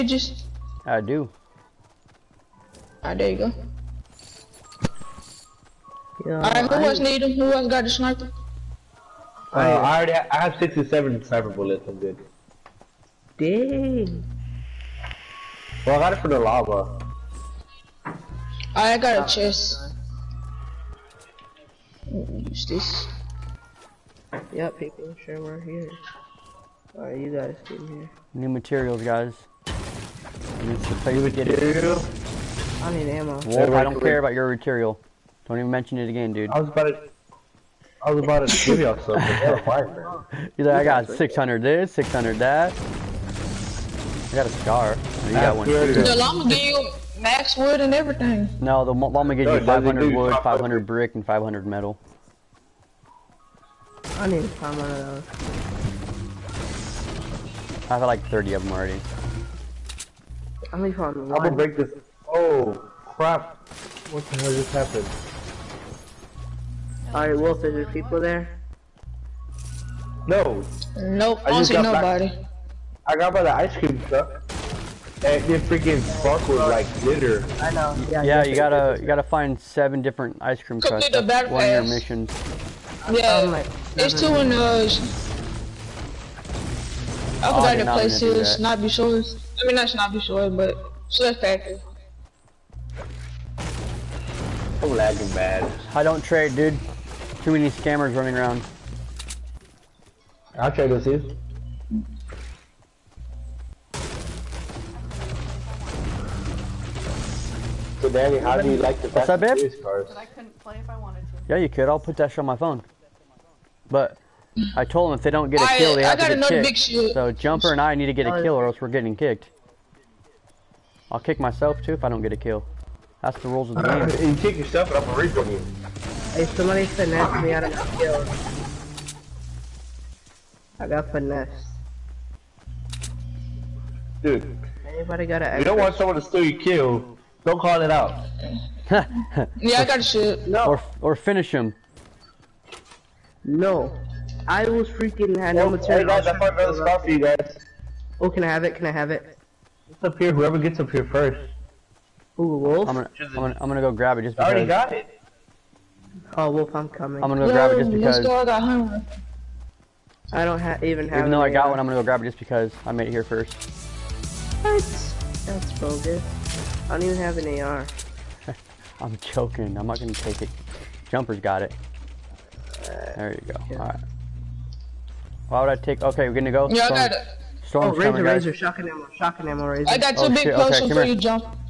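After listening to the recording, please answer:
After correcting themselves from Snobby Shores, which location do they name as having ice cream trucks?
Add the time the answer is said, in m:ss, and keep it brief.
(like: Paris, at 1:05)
Swift Factory, at 1:31.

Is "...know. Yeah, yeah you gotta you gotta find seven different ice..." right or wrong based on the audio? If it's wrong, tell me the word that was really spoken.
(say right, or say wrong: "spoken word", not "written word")
right.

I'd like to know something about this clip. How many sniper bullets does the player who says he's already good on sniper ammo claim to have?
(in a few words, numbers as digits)
67.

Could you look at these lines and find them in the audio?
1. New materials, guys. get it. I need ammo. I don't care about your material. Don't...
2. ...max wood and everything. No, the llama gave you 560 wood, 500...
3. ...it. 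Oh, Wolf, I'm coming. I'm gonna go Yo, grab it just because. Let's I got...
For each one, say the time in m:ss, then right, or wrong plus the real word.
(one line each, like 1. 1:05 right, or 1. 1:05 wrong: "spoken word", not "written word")
1. 0:28 right
2. 0:47 wrong: "500", not "560"
3. 2:34 right.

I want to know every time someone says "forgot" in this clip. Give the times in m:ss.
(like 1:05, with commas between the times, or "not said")
1:27.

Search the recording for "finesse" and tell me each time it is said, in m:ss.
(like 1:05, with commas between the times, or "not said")
2:06, 2:11.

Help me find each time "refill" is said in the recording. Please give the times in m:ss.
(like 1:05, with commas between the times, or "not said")
2:05.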